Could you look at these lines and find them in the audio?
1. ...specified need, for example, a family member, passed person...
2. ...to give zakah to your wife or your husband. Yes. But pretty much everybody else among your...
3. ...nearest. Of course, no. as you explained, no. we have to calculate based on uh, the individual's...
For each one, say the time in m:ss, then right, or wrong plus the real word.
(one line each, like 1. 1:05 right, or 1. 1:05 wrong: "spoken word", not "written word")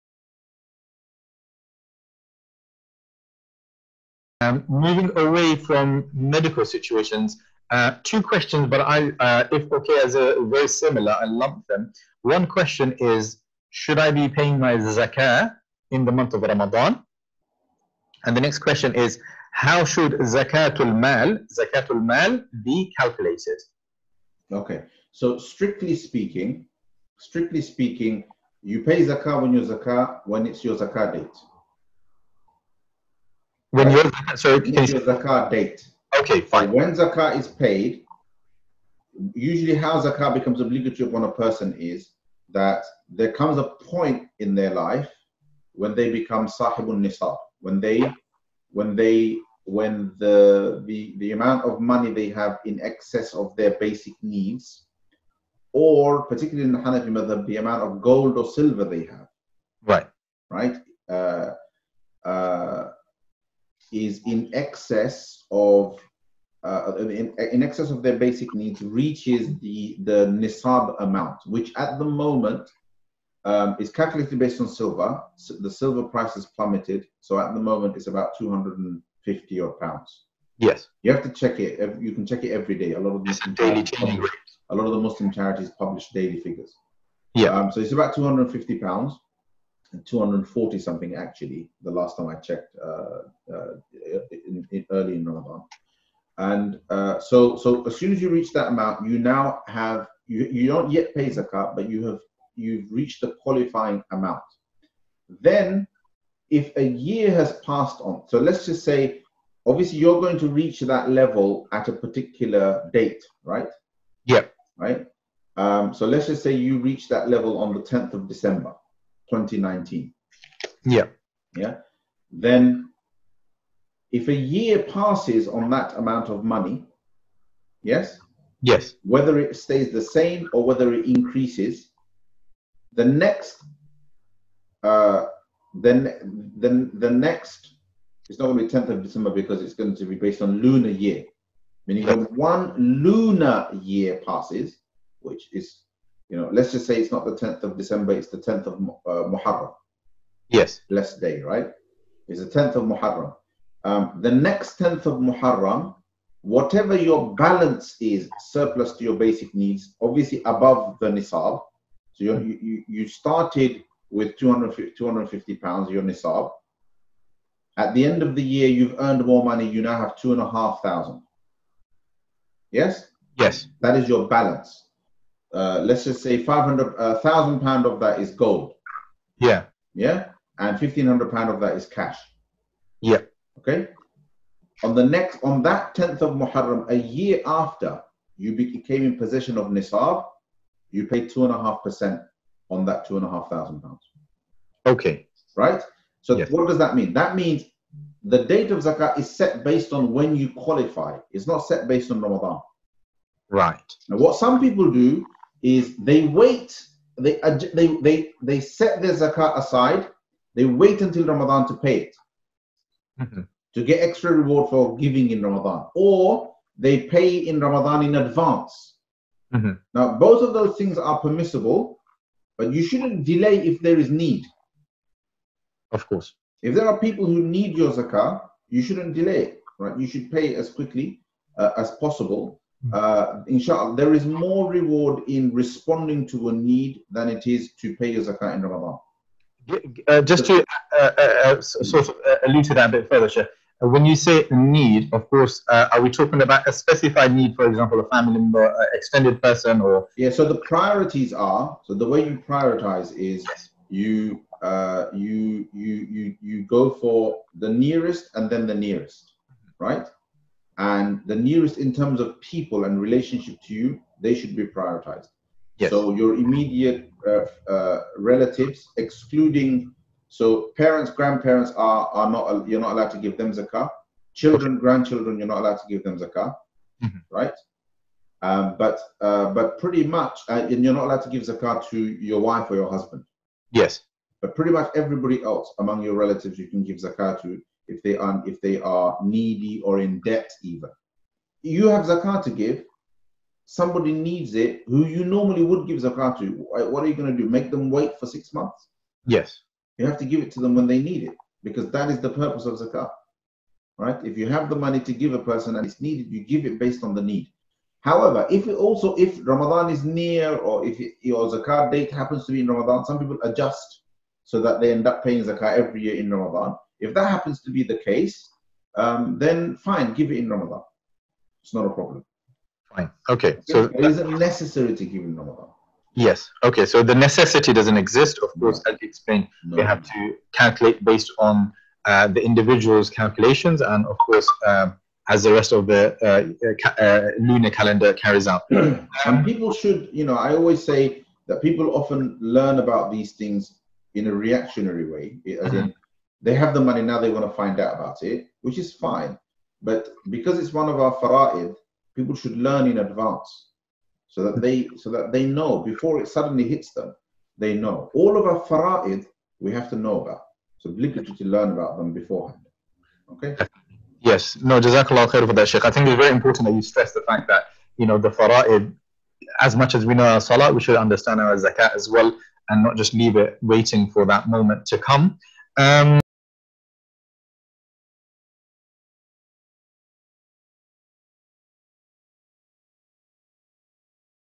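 1. 4:06 wrong: "extended", not "passed"
2. 4:41 right
3. 5:27 wrong: "exist", not "nearest".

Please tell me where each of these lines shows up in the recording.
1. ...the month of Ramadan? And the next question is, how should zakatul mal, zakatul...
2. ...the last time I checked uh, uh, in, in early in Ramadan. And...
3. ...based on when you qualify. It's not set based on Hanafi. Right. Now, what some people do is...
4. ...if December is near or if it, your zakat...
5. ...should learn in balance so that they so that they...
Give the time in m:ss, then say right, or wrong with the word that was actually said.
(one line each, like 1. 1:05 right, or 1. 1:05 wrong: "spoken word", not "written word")
1. 0:16 right
2. 1:31 right
3. 3:19 wrong: "Ramadan", not "Hanafi"
4. 5:09 wrong: "Ramadan", not "December"
5. 5:52 wrong: "advance", not "balance".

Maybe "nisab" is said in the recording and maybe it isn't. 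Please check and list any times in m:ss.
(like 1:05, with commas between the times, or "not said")
0:46, 1:10, 2:41, 2:46, 3:09.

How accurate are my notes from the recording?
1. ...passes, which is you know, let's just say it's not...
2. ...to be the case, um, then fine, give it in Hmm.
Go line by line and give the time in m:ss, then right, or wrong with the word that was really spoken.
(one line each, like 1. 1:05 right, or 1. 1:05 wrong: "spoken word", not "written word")
1. 2:24 right
2. 5:17 wrong: "Ramadan", not "Hmm".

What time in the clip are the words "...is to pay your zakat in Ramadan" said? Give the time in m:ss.
3:57.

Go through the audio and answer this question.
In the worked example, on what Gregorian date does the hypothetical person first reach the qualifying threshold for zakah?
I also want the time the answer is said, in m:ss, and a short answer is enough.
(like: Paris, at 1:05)
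10th of December 2019, at 1:57.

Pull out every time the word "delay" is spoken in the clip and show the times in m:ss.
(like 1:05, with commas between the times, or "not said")
3:43, 3:49.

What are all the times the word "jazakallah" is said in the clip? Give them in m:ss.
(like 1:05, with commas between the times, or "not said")
6:04.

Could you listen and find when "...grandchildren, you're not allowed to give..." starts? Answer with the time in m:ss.
4:34.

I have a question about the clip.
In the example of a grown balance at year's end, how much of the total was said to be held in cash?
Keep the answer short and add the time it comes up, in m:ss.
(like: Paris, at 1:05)
£1,500, at 3:00.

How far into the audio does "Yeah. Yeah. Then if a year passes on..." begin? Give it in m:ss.
2:00.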